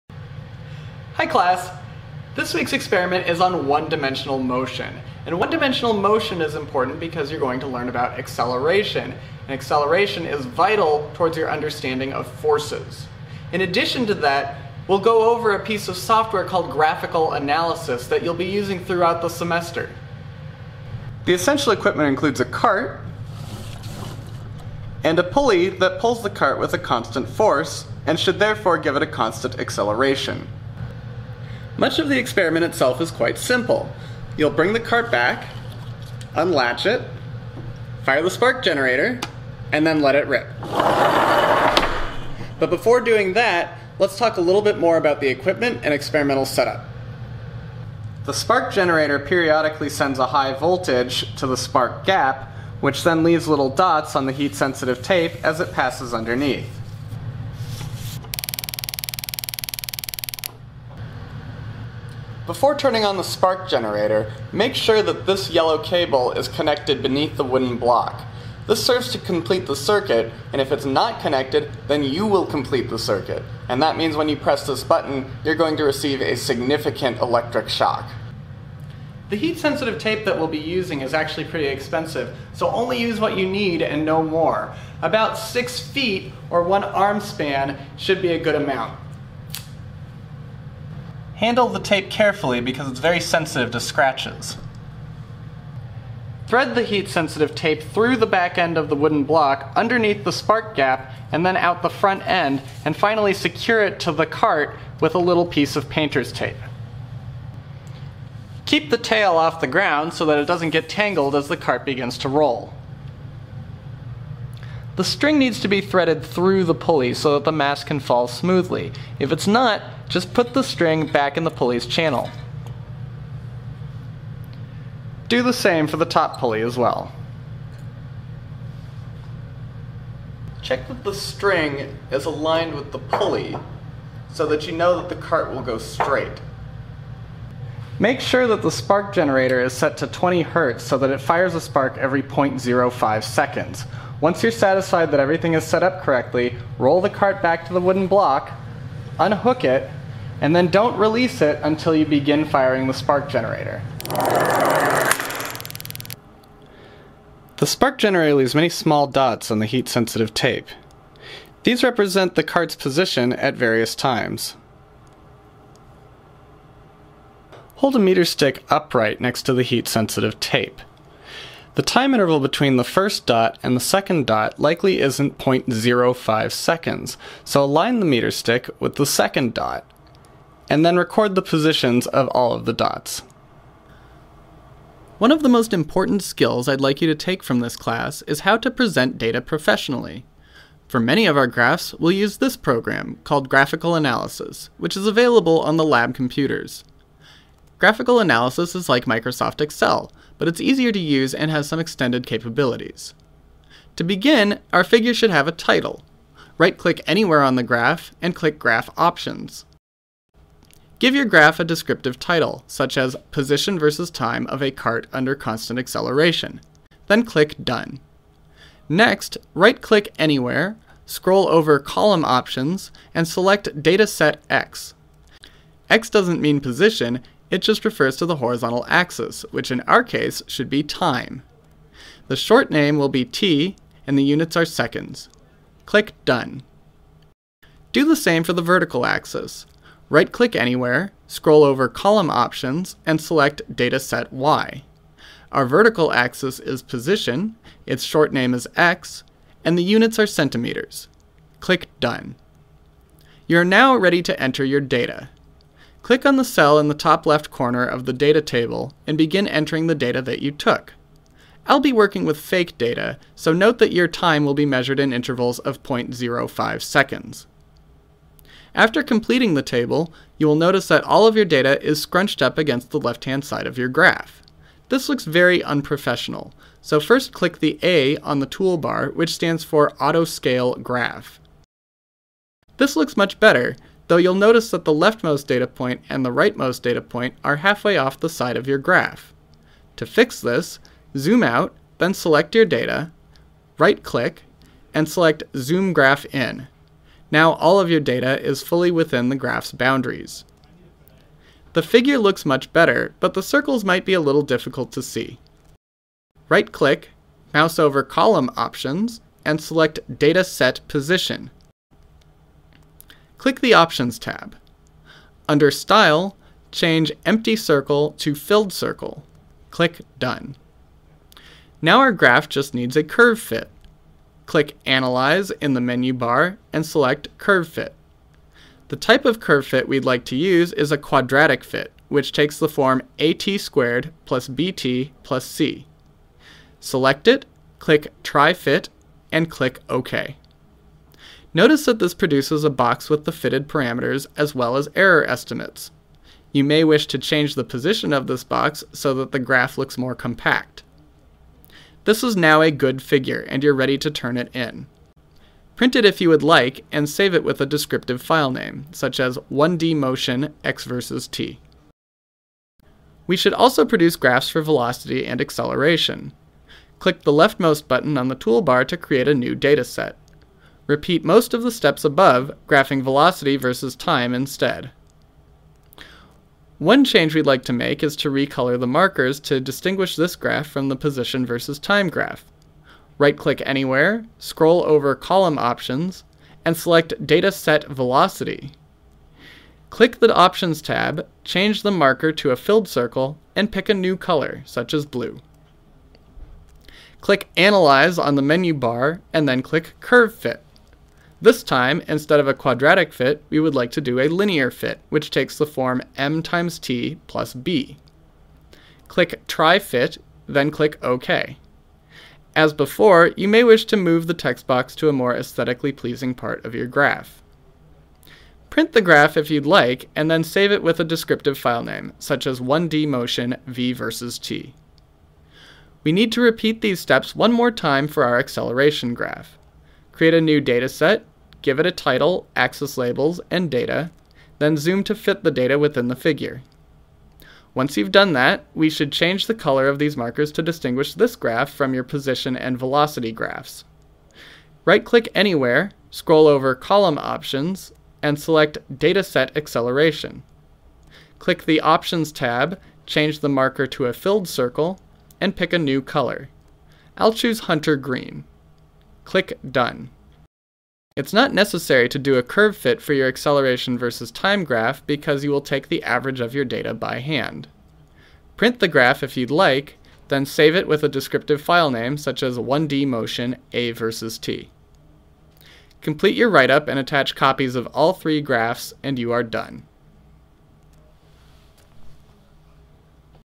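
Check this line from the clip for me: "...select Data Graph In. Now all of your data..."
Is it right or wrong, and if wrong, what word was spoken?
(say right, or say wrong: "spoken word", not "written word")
wrong: "Zoom", not "Data".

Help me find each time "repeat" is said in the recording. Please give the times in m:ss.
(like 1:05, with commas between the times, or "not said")
6:10, 7:06.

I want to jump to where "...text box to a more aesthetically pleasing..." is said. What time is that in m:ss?
6:54.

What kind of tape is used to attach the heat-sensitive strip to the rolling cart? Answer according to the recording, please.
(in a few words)
Painter's tape.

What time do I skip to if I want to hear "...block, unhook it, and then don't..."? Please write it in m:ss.
2:28.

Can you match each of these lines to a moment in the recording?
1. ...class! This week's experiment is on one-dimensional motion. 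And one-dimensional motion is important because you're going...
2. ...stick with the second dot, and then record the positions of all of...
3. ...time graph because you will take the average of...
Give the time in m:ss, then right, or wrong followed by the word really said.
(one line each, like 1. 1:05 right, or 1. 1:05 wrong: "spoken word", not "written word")
1. 0:01 right
2. 2:58 right
3. 7:44 right.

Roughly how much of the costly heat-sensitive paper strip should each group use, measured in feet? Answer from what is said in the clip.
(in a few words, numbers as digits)
6 feet.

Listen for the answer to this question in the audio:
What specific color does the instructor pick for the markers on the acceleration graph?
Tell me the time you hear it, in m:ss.
7:37.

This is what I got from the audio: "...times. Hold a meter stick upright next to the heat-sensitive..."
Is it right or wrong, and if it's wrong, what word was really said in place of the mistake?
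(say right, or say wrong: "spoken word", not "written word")
right.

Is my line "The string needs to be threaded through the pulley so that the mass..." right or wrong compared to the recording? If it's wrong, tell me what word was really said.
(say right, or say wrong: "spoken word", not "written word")
right.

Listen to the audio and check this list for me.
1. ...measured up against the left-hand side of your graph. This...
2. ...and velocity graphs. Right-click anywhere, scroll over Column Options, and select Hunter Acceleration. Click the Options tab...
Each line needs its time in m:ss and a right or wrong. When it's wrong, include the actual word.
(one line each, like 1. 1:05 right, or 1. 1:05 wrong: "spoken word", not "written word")
1. 4:32 wrong: "scrunched", not "measured"
2. 7:22 wrong: "Dataset", not "Hunter".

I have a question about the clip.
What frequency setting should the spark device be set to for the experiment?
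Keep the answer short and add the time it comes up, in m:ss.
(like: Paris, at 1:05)
20 Hz, at 2:20.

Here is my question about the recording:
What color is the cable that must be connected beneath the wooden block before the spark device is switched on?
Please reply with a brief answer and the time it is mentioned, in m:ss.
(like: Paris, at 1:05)
Yellow, at 1:05.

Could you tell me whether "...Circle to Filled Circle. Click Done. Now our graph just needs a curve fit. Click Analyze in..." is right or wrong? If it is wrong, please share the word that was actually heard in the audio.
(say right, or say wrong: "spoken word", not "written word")
right.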